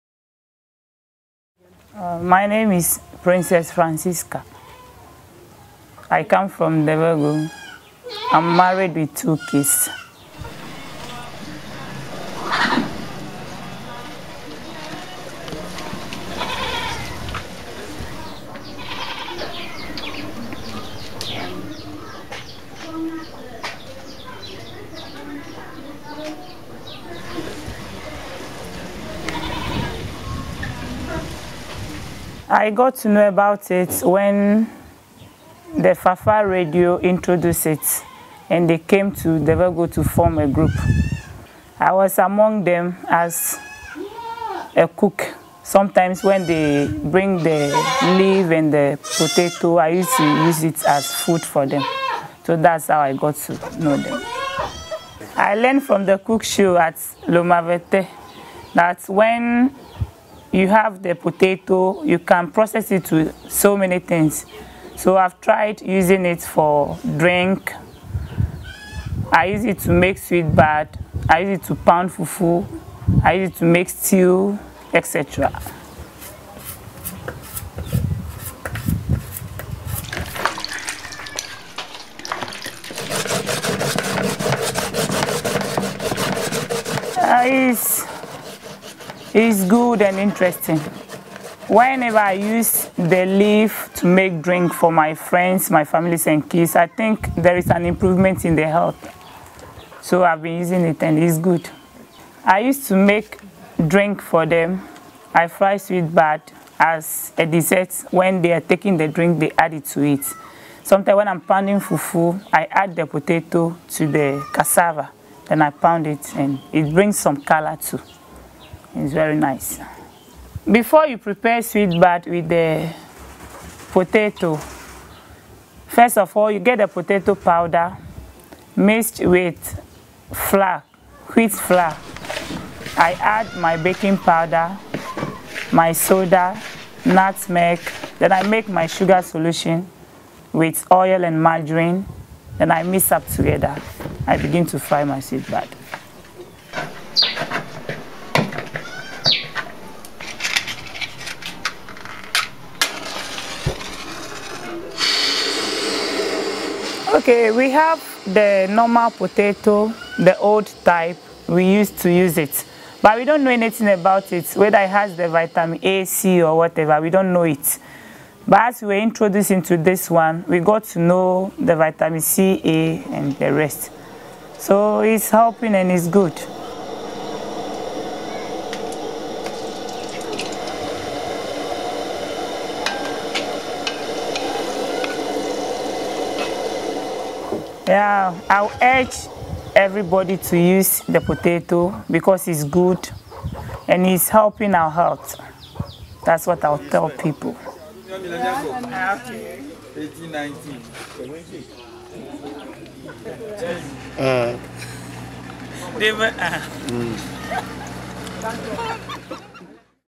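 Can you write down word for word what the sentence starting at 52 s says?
So that's how I got to know them.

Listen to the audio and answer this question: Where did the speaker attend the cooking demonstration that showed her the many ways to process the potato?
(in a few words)
Lume Avete.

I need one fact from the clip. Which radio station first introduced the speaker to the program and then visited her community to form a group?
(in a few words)
Fafaa radio.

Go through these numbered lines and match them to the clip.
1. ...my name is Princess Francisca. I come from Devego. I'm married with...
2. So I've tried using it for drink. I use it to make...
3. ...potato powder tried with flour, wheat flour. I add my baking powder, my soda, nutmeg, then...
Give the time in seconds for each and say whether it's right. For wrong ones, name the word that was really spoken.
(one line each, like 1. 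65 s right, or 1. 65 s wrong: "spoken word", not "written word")
1. 2 s right
2. 64 s right
3. 126 s wrong: "mixed", not "tried".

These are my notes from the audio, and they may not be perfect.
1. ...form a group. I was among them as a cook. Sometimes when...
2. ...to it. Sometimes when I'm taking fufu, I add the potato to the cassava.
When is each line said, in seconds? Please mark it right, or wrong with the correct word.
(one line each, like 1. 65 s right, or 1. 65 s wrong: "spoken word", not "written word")
1. 40 s right
2. 109 s wrong: "pounding", not "taking".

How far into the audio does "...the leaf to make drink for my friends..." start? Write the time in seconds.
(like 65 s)
92 s.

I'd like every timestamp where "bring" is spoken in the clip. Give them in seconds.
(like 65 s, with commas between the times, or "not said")
47 s, 116 s.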